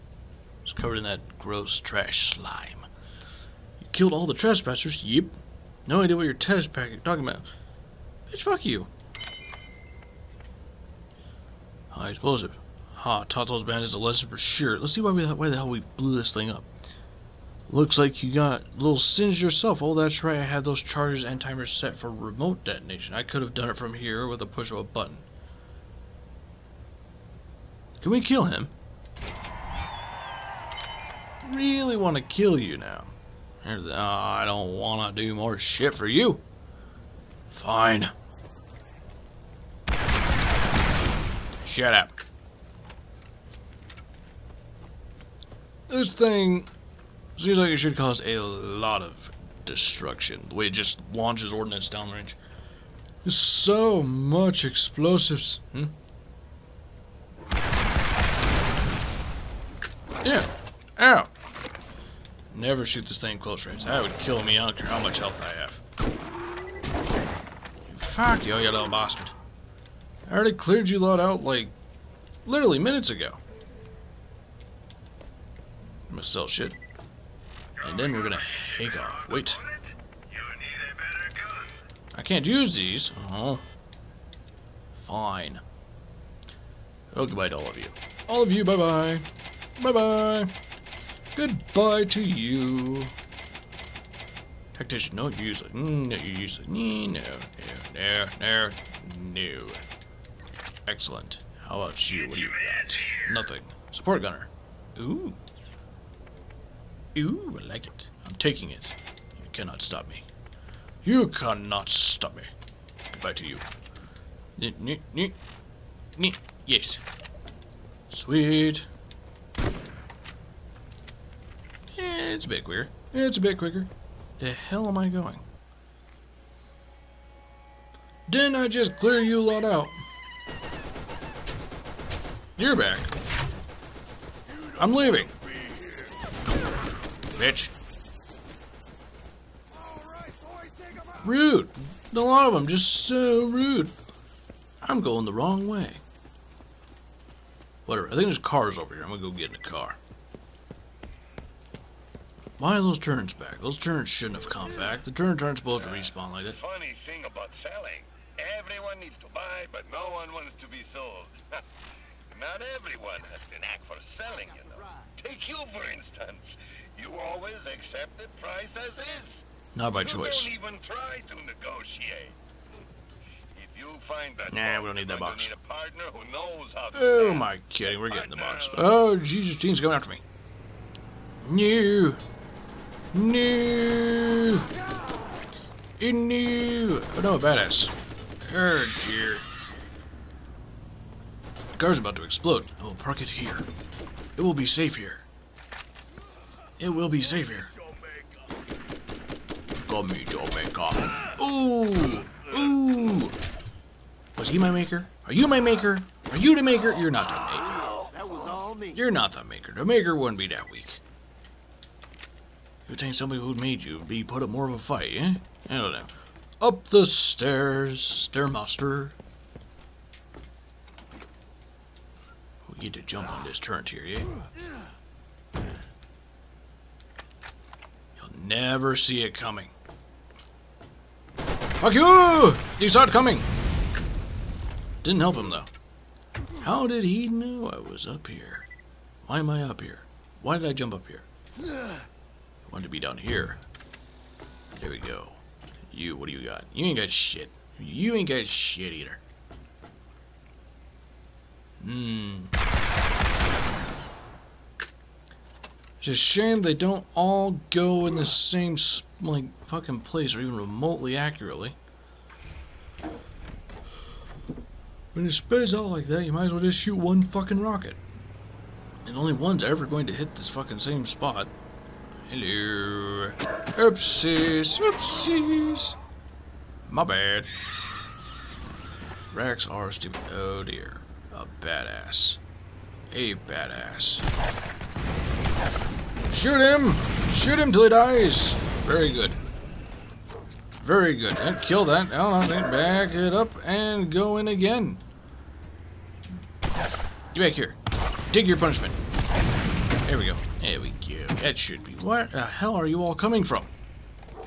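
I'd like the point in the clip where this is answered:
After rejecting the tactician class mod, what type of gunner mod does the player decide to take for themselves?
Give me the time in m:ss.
1:43.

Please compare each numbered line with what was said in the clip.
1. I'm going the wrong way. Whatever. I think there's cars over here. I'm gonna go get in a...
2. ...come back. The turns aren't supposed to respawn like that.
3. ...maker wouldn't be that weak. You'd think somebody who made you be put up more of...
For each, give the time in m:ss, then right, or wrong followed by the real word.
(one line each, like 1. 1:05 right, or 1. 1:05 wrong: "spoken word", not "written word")
1. 2:24 right
2. 2:34 right
3. 3:29 right.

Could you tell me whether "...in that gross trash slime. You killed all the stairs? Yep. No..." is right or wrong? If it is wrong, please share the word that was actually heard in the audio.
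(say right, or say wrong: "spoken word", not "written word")
wrong: "trespassers", not "stairs".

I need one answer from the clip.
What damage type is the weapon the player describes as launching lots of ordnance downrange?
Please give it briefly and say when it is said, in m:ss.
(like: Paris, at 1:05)
High explosive, at 0:11.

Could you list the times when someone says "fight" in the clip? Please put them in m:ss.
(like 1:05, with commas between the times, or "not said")
3:34.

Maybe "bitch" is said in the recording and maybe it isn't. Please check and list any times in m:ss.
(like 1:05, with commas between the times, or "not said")
0:08, 2:17.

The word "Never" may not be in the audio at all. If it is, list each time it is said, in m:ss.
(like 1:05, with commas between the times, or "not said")
1:02, 3:48.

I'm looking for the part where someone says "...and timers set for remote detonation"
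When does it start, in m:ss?
0:21.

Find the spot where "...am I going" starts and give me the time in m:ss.
2:04.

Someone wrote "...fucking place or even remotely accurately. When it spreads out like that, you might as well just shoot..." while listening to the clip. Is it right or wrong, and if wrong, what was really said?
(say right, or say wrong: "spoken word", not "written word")
right.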